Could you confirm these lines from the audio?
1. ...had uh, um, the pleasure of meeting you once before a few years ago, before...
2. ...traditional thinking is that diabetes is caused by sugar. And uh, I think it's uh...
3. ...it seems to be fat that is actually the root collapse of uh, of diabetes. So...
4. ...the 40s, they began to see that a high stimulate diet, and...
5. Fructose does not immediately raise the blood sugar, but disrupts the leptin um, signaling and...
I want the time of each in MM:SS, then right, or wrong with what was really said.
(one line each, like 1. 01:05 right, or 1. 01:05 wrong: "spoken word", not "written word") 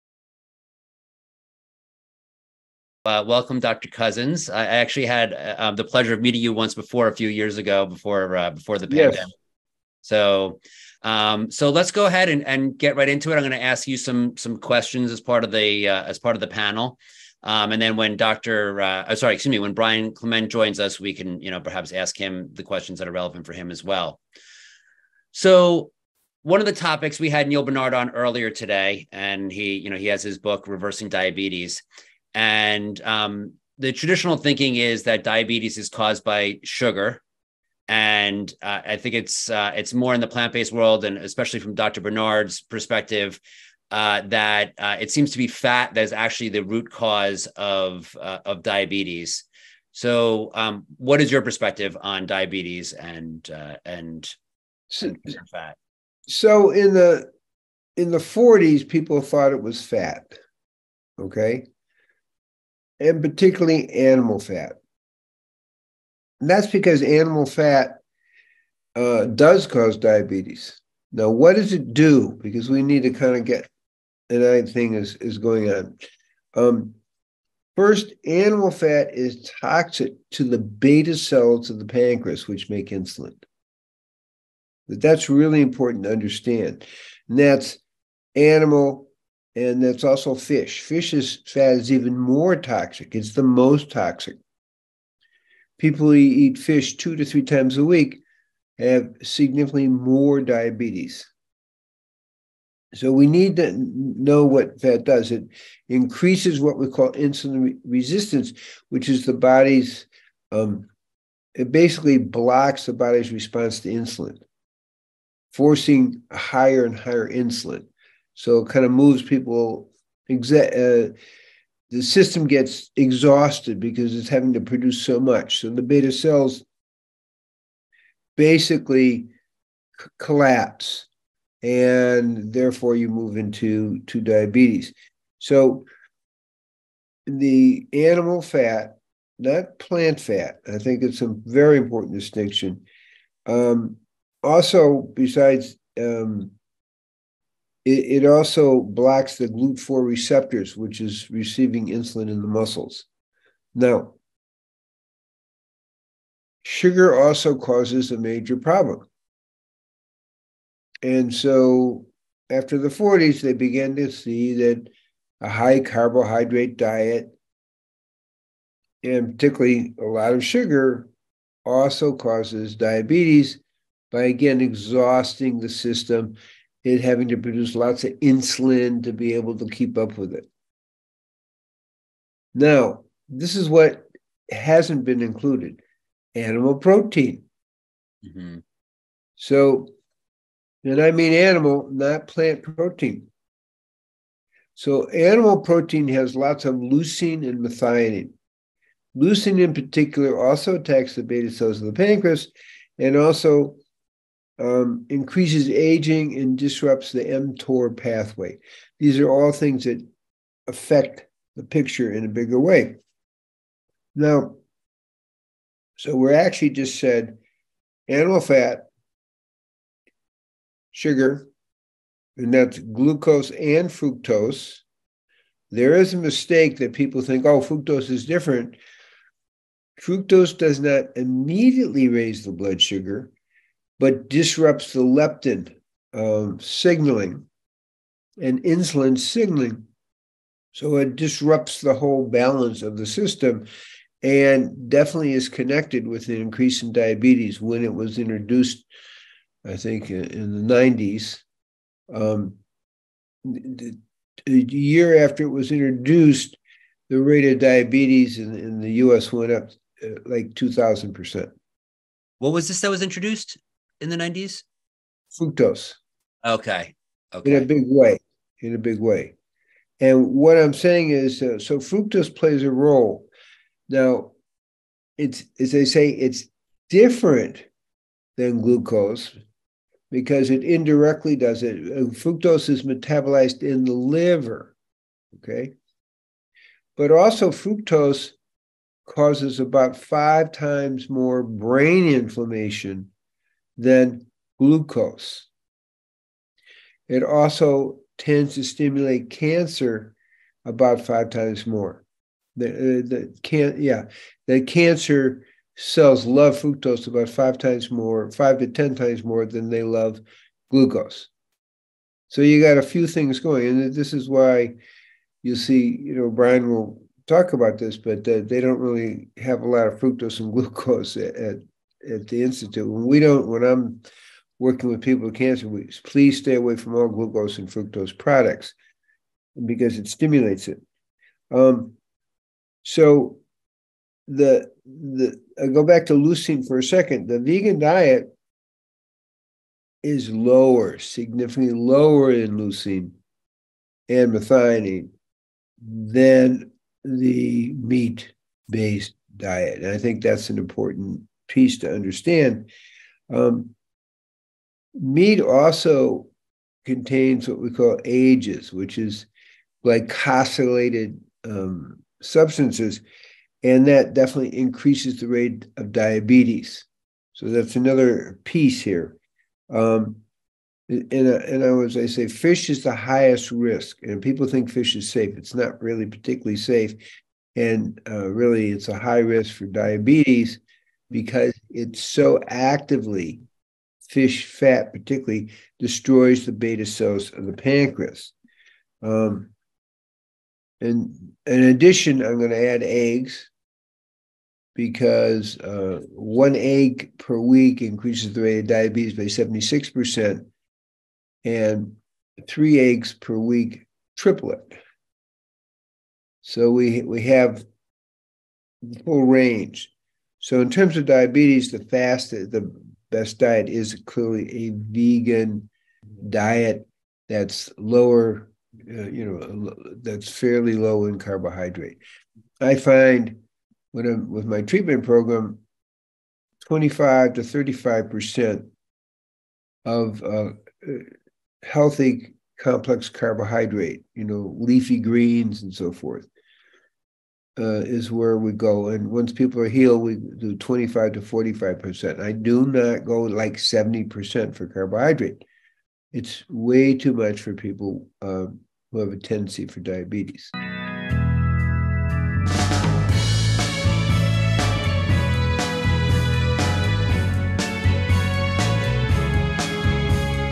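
1. 00:05 right
2. 00:33 right
3. 00:45 wrong: "cause", not "collapse"
4. 02:42 wrong: "carbohydrate", not "stimulate"
5. 03:50 right.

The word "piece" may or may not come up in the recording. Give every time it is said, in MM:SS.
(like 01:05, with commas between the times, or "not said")
05:51, 06:08.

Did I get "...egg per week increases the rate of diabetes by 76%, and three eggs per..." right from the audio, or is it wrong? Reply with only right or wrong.
right.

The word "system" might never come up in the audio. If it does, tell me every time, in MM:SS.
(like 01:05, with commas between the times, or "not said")
02:02, 02:55, 04:03.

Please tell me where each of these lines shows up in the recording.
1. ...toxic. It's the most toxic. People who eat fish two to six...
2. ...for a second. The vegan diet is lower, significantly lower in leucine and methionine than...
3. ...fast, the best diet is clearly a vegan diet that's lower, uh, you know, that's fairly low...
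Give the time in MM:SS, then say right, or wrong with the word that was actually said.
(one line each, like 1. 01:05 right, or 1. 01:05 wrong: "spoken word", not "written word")
1. 01:32 wrong: "three", not "six"
2. 05:36 right
3. 06:51 right.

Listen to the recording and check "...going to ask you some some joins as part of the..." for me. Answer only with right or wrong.
wrong.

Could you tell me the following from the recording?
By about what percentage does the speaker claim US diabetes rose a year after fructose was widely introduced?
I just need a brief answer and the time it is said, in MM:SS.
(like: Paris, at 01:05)
2,000%, at 04:20.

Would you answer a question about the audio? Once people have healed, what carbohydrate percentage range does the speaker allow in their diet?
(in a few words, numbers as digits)
25 to 45%.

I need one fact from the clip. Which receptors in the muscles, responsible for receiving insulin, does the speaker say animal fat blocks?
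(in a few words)
GLUT4.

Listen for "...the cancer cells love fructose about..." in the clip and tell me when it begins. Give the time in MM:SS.
05:04.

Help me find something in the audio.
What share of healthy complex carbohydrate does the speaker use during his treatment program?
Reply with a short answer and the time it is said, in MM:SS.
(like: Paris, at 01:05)
25 to 35 percent, at 07:06.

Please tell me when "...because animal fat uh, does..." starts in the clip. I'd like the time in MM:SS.
01:06.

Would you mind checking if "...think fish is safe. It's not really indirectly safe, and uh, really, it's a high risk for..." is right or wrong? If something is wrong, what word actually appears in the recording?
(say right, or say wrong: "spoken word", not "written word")
wrong: "particularly", not "indirectly".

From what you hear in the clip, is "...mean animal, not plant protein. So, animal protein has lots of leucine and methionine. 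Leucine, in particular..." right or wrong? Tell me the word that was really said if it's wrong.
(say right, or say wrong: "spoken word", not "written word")
right.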